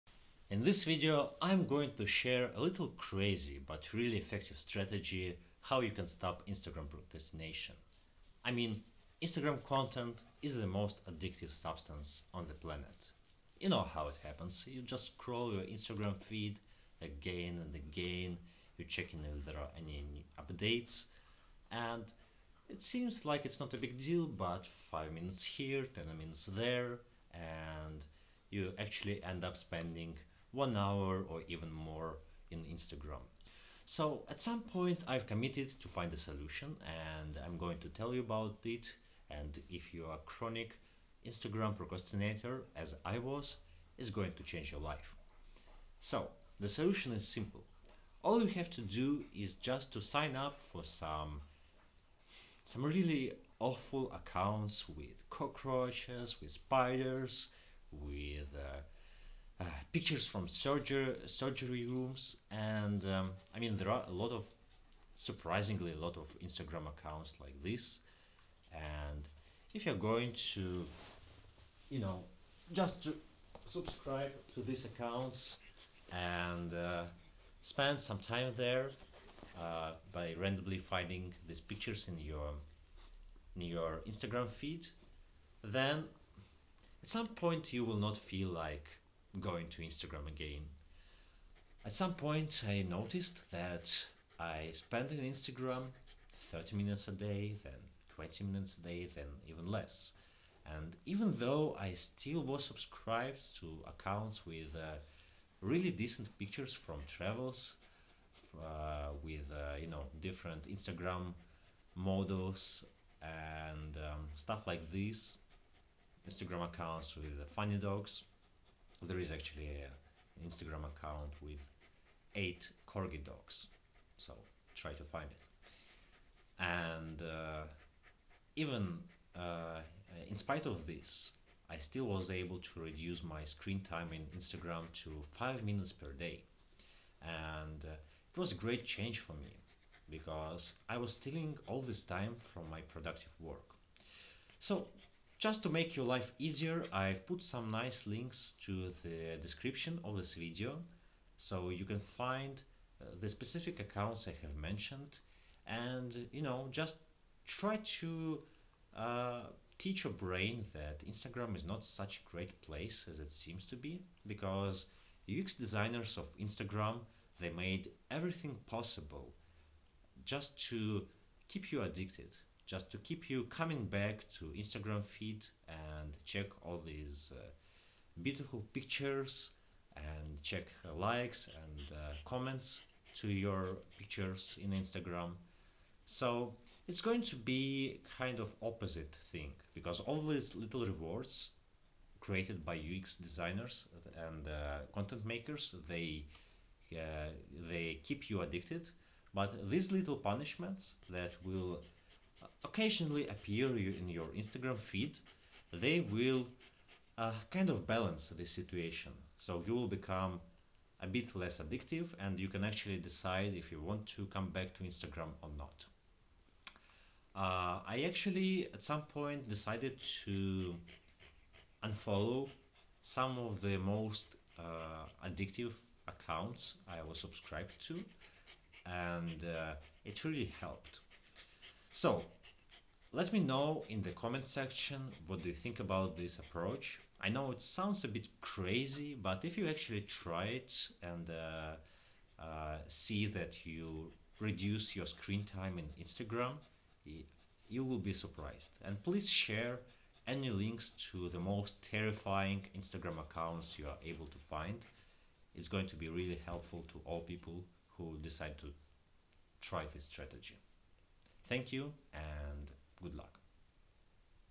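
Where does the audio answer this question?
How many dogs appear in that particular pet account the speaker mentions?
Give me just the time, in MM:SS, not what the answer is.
02:02.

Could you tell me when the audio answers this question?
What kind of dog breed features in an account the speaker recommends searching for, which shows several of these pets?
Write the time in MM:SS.
02:02.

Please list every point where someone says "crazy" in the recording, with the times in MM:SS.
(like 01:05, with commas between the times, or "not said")
00:02, 03:58.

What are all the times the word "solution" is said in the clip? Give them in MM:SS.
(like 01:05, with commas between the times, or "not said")
00:36, 00:46.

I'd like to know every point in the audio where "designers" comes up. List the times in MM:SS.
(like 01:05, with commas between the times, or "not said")
02:45, 03:13.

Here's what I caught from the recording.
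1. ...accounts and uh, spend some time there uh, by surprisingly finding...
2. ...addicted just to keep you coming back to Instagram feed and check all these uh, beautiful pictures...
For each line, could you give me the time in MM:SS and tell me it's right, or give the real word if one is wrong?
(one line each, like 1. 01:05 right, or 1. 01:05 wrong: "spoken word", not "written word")
1. 01:14 wrong: "randomly", not "surprisingly"
2. 02:51 right.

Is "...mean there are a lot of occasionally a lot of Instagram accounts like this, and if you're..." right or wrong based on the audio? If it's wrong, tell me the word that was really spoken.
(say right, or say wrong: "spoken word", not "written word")
wrong: "surprisingly", not "occasionally".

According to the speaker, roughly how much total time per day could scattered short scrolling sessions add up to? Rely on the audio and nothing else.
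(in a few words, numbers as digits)
1 hour.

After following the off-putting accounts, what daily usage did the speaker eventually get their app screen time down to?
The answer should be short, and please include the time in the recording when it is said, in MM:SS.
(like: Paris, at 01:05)
5 minutes, at 02:15.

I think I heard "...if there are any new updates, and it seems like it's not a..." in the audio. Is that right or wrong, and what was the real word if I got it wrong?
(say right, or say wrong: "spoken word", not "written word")
right.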